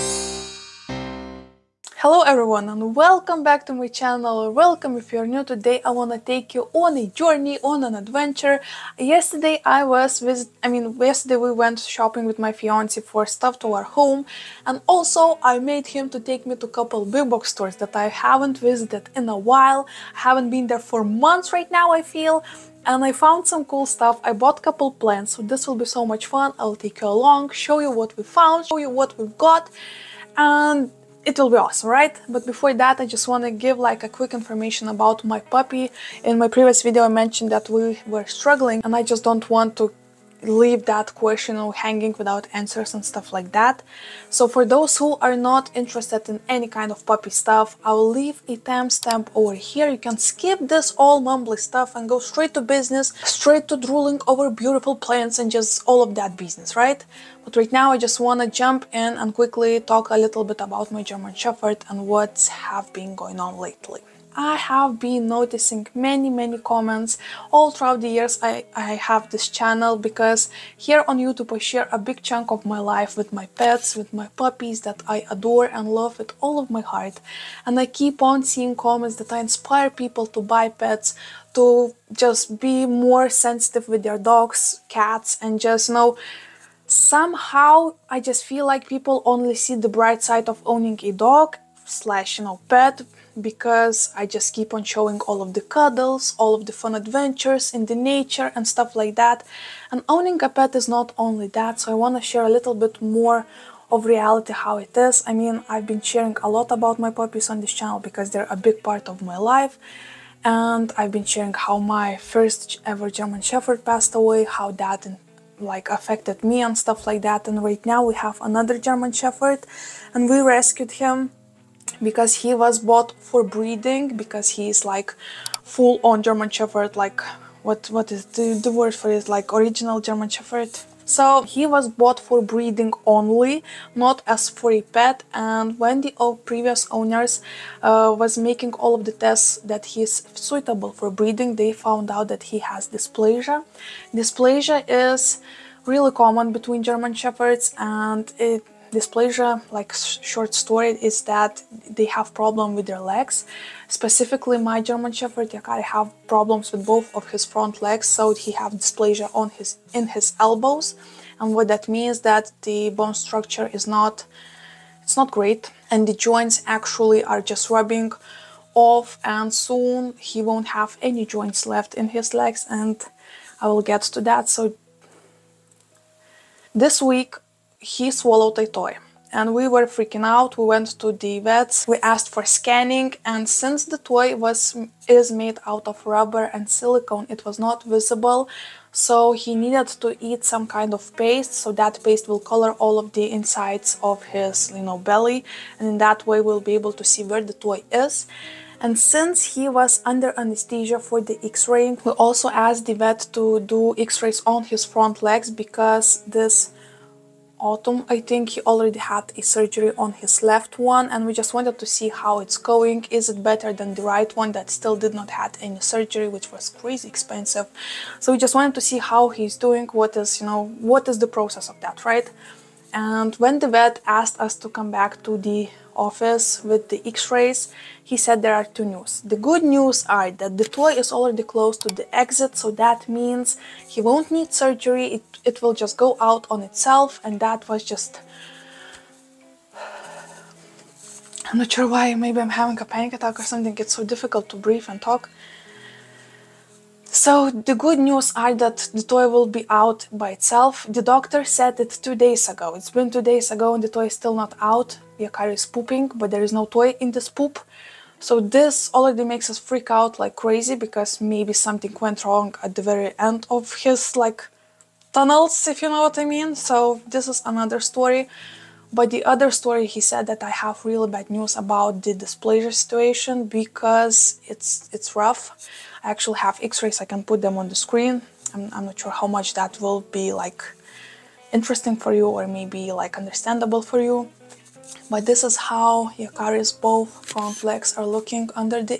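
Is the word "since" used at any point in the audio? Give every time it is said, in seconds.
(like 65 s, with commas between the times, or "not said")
183 s, 198 s.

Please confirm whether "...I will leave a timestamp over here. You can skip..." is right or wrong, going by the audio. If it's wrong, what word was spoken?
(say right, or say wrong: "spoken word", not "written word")
right.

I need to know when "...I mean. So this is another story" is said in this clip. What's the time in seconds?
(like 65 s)
266 s.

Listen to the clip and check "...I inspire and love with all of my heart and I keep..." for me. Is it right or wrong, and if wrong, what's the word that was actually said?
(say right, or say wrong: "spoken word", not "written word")
wrong: "adore", not "inspire".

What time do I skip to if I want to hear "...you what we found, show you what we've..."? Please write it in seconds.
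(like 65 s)
27 s.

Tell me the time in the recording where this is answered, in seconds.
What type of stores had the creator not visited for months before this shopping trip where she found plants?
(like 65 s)
17 s.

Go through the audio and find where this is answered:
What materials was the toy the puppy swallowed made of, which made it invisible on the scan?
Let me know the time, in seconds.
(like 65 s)
186 s.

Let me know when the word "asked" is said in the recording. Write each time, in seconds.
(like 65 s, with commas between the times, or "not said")
181 s, 202 s, 224 s.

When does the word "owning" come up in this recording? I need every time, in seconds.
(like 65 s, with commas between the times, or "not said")
90 s, 100 s.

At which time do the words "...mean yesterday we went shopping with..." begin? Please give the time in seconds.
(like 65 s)
10 s.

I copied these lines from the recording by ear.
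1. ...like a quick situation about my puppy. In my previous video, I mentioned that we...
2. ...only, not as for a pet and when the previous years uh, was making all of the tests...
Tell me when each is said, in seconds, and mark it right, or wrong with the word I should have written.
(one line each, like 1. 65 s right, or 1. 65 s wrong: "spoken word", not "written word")
1. 33 s wrong: "information", not "situation"
2. 133 s wrong: "owners", not "years".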